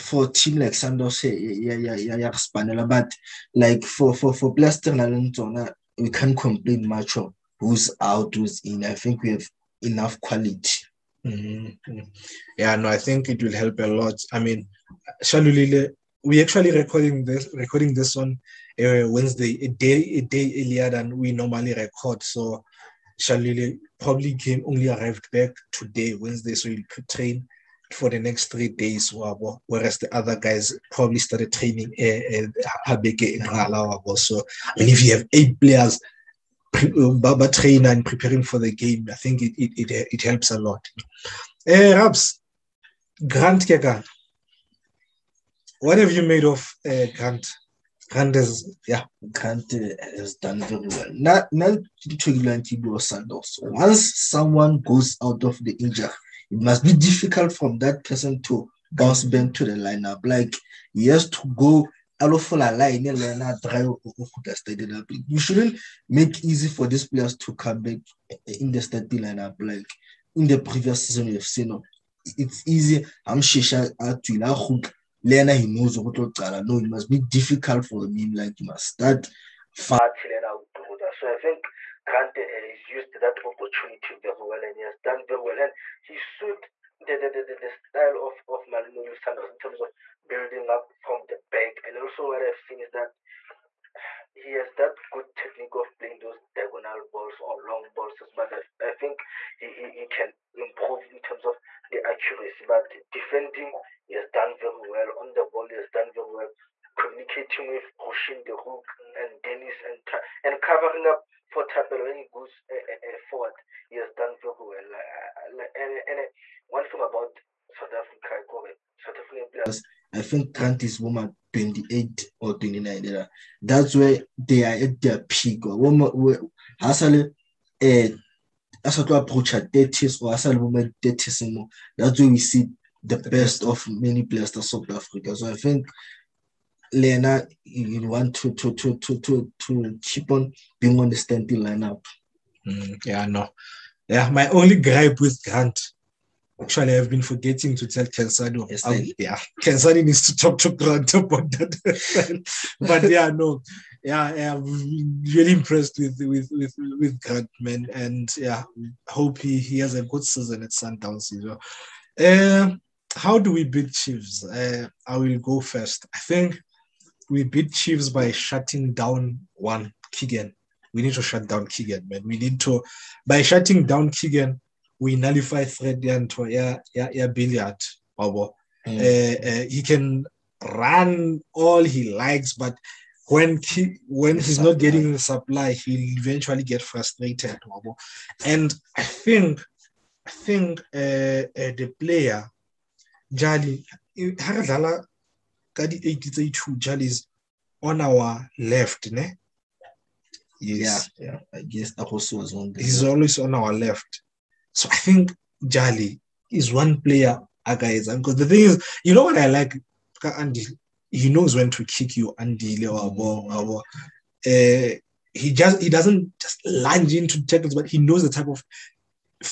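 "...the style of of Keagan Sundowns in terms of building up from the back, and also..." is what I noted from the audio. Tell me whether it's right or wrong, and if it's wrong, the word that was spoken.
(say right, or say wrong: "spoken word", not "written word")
wrong: "Mamelodi", not "Keagan".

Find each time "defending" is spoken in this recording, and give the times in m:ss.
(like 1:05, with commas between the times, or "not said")
1:43.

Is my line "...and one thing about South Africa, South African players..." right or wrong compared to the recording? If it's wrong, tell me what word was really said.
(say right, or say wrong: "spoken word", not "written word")
right.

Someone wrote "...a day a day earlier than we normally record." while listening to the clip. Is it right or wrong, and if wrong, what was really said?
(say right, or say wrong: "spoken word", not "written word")
right.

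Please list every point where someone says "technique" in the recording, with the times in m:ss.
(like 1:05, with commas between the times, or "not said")
1:35.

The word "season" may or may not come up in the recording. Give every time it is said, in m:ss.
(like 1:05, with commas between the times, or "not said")
1:11, 2:40.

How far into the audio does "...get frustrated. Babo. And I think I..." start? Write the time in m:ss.
3:06.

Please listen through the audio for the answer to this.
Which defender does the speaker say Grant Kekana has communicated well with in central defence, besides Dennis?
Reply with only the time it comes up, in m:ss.
1:47.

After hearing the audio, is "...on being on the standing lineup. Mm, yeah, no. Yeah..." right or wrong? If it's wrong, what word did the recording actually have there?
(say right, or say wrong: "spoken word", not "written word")
right.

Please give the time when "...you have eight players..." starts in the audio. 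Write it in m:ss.
0:35.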